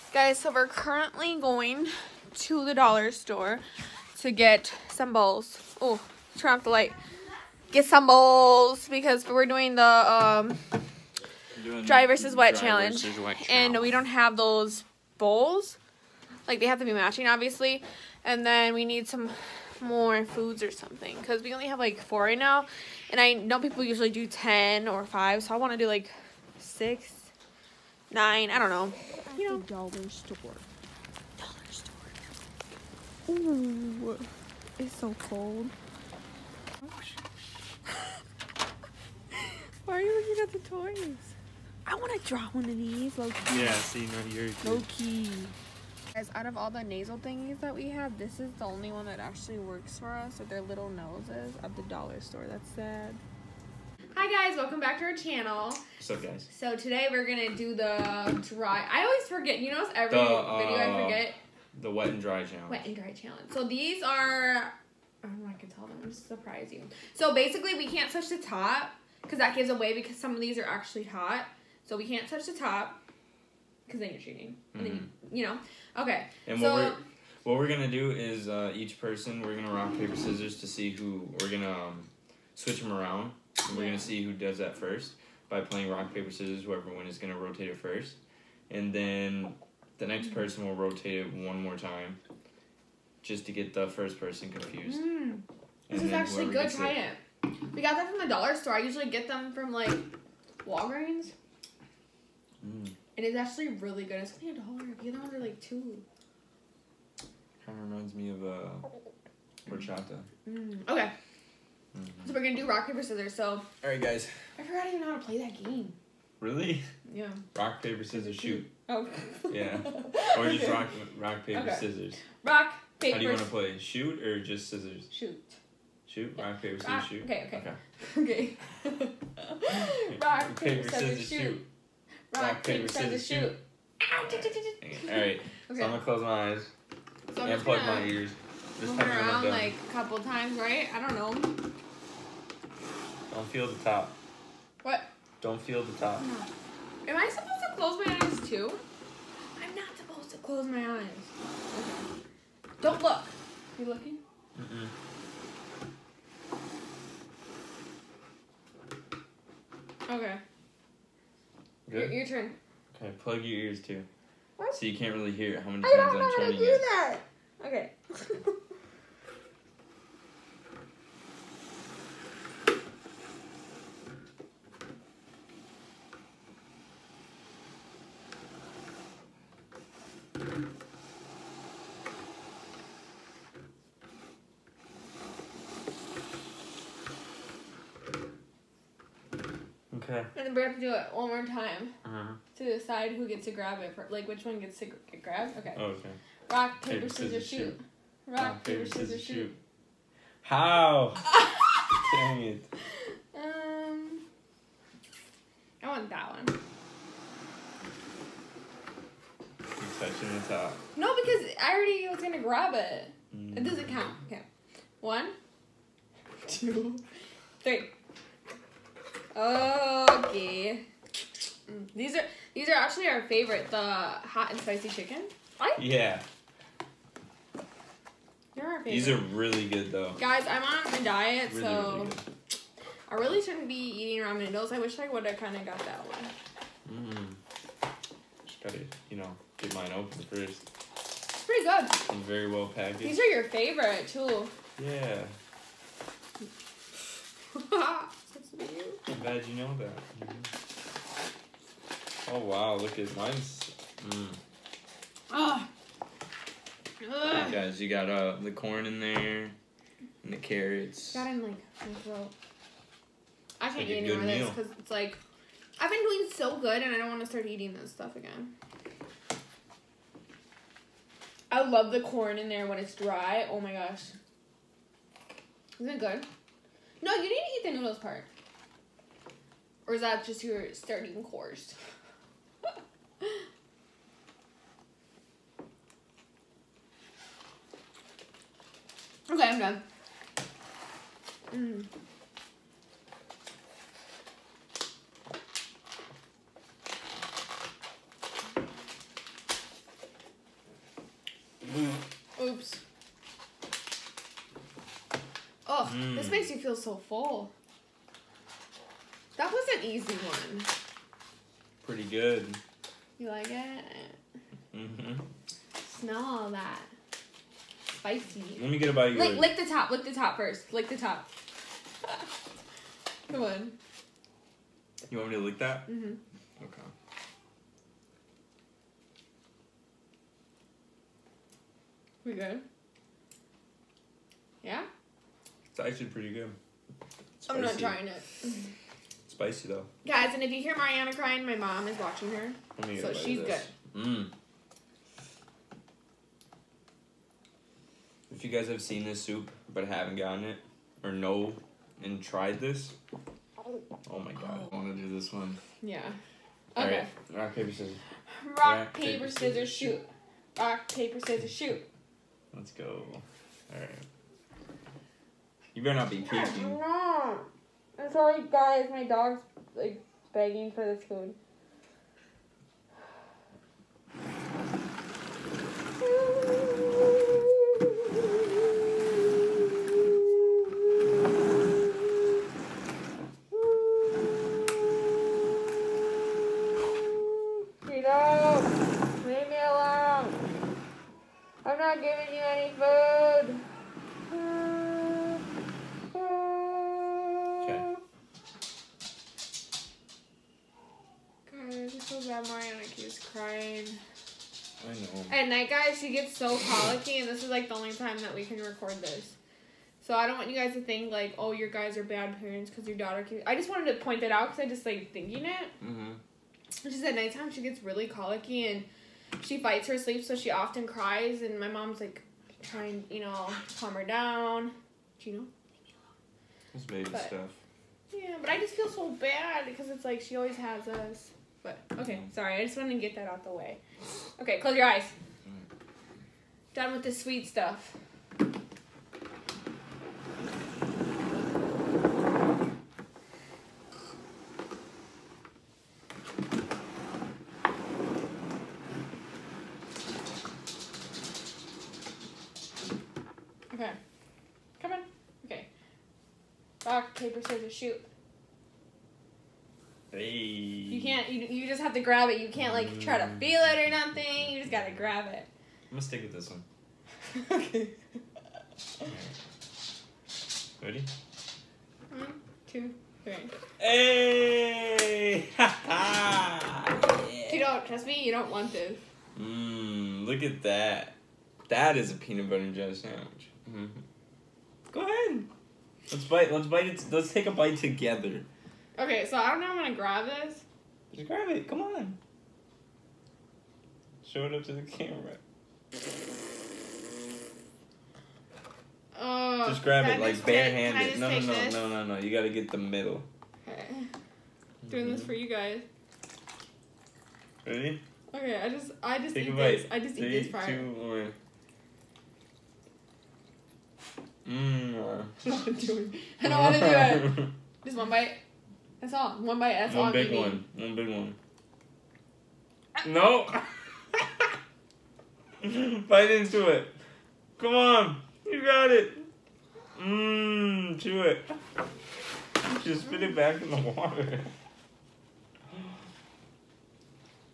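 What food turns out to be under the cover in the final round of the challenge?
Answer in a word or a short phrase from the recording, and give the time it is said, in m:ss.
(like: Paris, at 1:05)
peanut butter and jelly sandwich, at 8:02.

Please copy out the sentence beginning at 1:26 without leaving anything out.
Whoever wins is going to rotate it first.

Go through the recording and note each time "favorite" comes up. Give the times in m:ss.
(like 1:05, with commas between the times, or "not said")
3:43, 3:48, 4:03.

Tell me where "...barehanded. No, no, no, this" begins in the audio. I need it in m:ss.
8:20.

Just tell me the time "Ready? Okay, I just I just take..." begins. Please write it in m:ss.
8:27.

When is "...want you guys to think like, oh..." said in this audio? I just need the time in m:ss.
6:50.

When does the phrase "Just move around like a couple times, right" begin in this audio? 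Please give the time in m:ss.
2:18.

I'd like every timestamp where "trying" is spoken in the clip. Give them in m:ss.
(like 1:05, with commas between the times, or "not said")
5:37, 7:02.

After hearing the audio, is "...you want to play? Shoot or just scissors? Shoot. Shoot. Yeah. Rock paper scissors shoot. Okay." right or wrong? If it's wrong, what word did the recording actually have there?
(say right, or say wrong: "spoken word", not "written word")
right.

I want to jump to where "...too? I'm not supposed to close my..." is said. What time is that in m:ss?
2:28.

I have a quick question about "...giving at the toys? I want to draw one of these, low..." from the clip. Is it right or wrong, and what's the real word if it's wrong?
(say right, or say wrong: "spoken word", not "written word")
wrong: "looking", not "giving".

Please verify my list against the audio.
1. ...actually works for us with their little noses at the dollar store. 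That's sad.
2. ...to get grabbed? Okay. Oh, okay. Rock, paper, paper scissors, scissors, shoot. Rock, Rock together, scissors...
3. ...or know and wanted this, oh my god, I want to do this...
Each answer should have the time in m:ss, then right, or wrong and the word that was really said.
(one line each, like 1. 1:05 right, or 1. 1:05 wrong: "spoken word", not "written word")
1. 0:49 right
2. 3:14 wrong: "paper", not "together"
3. 5:51 wrong: "tried", not "wanted".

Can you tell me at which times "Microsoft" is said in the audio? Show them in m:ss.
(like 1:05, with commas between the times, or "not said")
not said.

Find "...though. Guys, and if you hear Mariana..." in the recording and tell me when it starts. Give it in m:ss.
5:39.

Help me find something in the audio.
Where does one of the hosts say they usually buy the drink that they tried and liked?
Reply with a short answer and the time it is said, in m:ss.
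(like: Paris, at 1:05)
Walgreens, at 1:40.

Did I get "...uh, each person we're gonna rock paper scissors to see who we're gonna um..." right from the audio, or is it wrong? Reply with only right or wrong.
right.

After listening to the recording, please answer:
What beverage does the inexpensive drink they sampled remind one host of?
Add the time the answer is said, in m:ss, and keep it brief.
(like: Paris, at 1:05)
horchata, at 1:49.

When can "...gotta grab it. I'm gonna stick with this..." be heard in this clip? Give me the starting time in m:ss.
7:44.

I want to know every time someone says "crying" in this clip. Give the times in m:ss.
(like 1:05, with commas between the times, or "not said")
5:41, 6:43.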